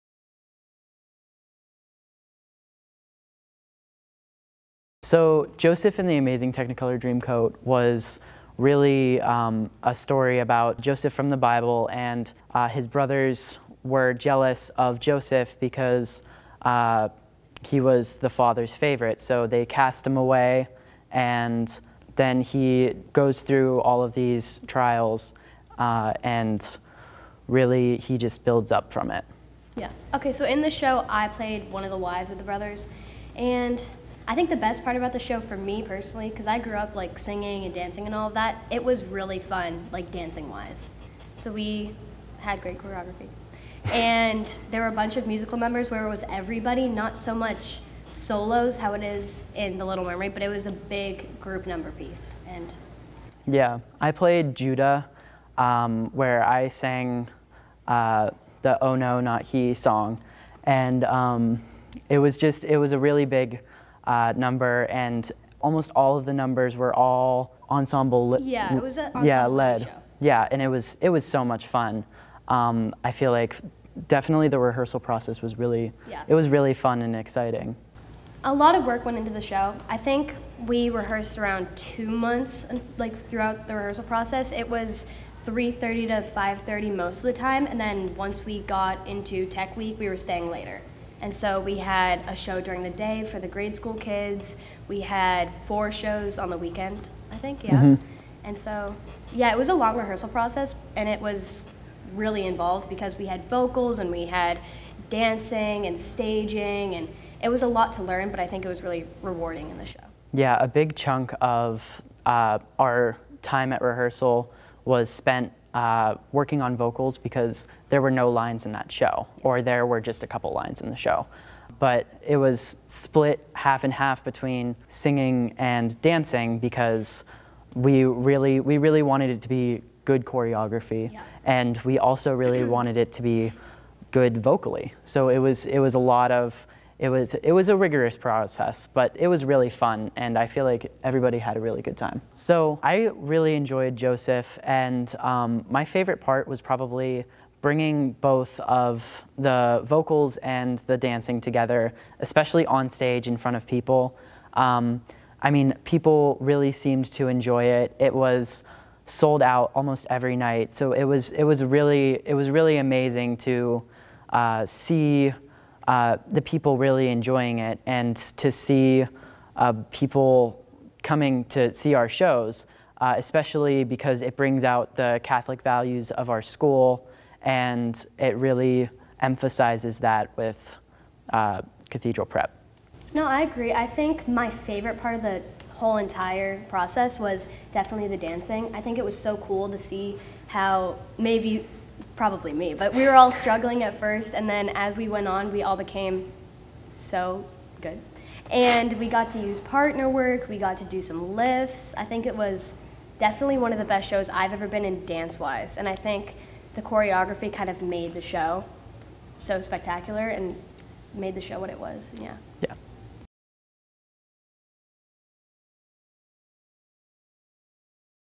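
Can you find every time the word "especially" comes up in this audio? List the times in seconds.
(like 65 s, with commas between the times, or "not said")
152 s, 173 s.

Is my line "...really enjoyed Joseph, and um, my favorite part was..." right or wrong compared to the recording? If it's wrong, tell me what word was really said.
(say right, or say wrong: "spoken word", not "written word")
right.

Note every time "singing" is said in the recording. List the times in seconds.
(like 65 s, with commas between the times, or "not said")
37 s, 124 s.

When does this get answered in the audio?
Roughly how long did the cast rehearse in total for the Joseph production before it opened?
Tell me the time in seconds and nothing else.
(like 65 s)
81 s.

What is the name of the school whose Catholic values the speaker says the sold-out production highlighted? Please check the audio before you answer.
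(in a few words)
Cathedral Prep.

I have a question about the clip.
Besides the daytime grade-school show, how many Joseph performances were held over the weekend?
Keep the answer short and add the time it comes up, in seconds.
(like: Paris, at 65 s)
4, at 95 s.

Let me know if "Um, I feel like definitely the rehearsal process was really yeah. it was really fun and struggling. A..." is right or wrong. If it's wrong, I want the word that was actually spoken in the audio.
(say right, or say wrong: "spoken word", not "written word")
wrong: "exciting", not "struggling".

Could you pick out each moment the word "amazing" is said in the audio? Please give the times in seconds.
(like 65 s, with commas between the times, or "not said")
6 s, 162 s.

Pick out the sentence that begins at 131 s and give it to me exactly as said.
and we also really wanted it to be good vocally.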